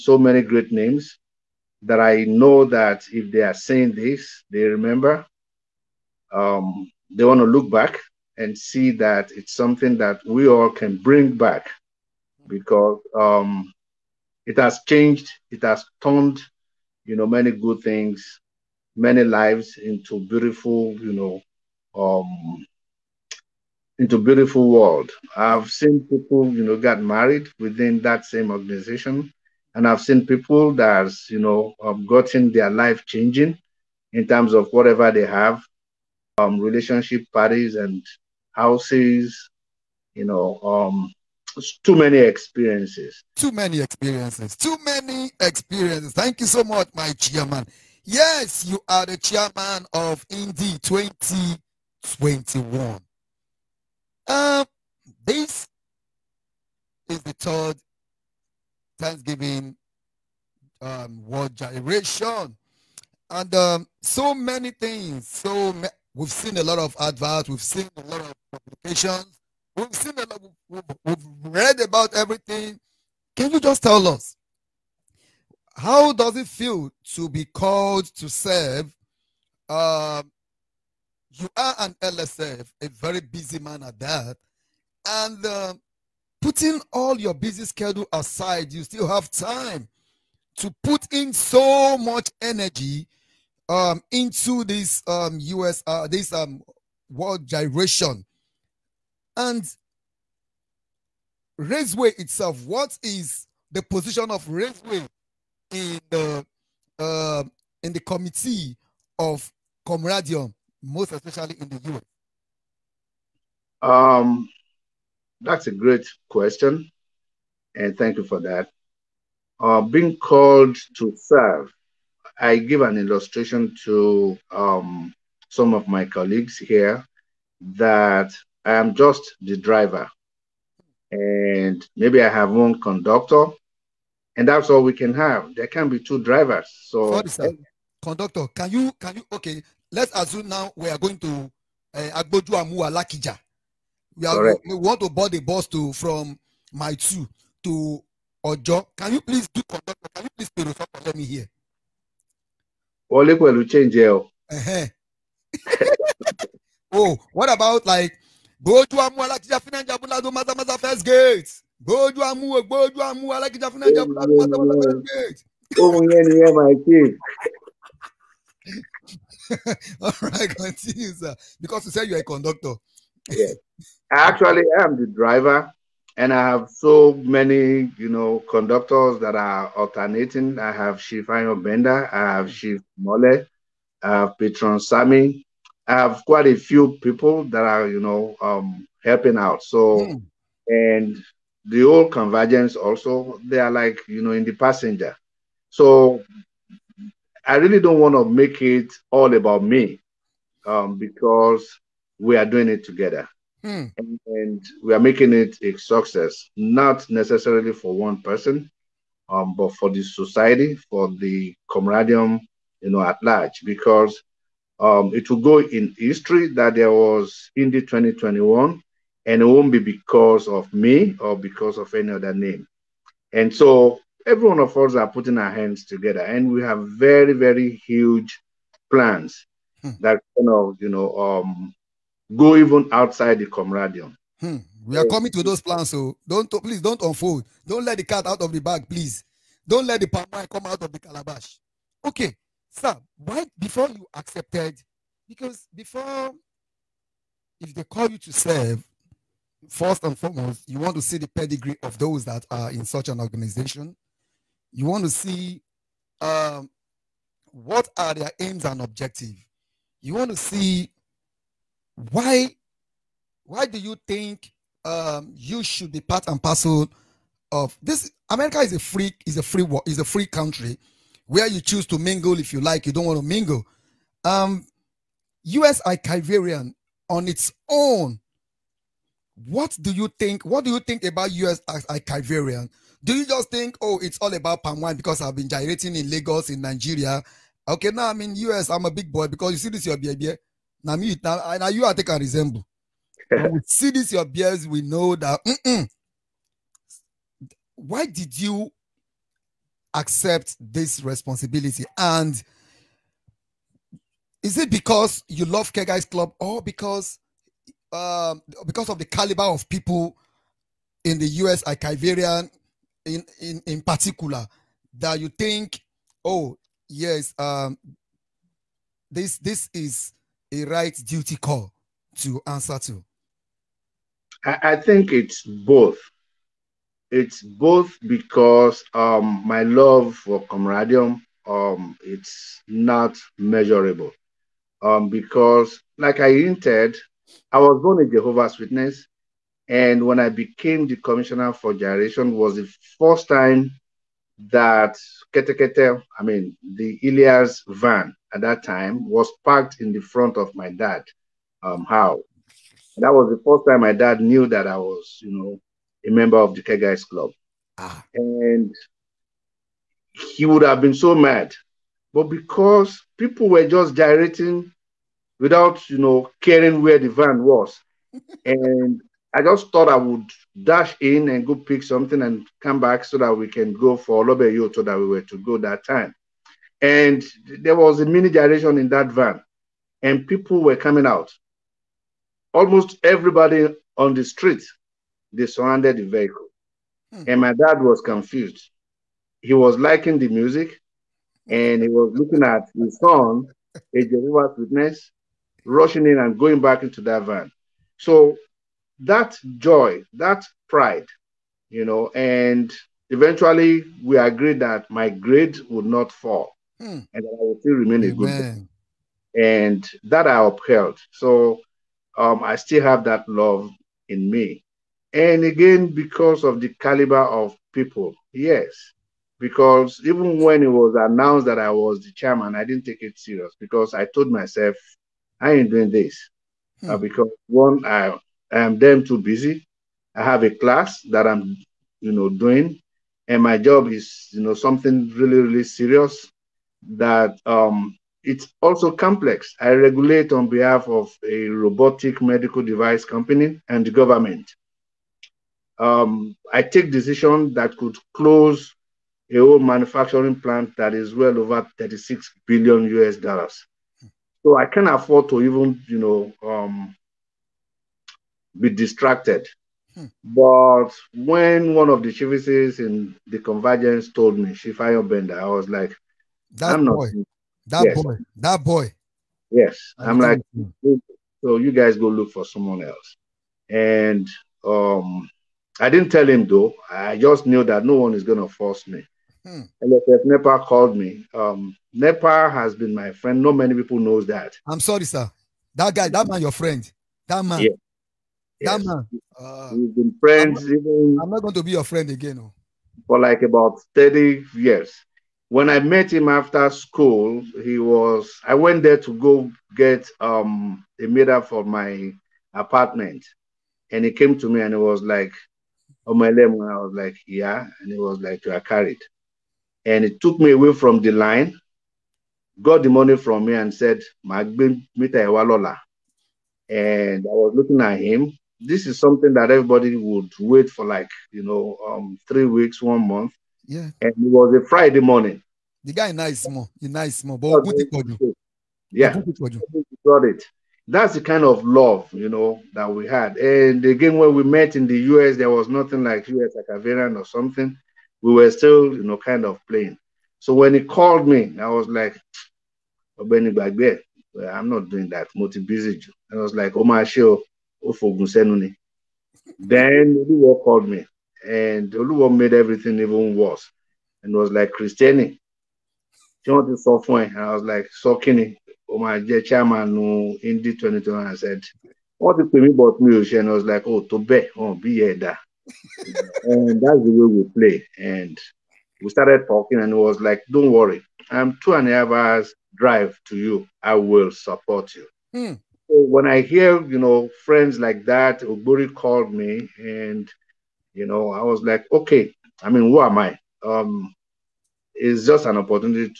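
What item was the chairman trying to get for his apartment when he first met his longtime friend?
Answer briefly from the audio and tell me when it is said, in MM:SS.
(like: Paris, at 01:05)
a meter, at 08:21.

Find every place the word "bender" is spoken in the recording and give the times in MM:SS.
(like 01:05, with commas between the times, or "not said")
03:01, 07:45.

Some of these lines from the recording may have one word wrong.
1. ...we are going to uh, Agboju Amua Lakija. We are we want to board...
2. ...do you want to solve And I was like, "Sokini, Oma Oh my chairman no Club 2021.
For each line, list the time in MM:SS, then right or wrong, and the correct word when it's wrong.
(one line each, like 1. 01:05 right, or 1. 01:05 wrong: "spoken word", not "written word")
1. 02:20 right
2. 09:16 wrong: "Indy", not "Club".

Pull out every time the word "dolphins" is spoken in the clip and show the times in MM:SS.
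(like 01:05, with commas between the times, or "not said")
not said.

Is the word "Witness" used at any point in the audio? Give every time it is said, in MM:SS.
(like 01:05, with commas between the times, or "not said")
05:38, 06:34.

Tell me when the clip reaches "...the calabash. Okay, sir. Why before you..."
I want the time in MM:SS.
04:00.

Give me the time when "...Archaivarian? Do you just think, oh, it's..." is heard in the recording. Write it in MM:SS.
04:41.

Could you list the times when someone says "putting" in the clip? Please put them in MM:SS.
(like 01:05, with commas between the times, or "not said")
01:26, 03:45.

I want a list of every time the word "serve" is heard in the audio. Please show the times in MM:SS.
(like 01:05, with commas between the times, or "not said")
01:18, 02:01, 04:08.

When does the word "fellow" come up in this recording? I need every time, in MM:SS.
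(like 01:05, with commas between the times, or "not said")
not said.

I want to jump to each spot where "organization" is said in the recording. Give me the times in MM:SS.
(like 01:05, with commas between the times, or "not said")
00:28, 04:13.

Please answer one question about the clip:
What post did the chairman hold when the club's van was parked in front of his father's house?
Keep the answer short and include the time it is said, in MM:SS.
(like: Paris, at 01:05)
commissioner for generation, at 05:40.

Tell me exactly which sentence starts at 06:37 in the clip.
So that joy, that pride, you know, and eventually we agreed that my grade would not fall hmm.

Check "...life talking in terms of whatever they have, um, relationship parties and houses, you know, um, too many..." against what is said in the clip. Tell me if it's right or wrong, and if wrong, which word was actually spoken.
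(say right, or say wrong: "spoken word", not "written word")
wrong: "changing", not "talking".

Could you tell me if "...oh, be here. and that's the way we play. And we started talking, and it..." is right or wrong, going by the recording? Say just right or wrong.
right.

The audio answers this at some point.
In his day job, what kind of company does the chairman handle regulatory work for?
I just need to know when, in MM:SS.
07:21.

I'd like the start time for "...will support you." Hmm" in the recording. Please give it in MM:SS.
09:33.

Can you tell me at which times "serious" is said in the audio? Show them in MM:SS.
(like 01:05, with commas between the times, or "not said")
07:03, 07:15.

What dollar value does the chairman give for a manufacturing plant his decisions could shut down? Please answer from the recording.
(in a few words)
$36 billion.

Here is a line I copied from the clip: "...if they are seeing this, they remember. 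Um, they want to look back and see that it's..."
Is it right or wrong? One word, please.
right.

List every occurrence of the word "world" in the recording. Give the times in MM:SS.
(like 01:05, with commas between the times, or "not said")
00:24, 01:01, 01:37.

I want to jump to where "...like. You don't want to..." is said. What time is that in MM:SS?
04:32.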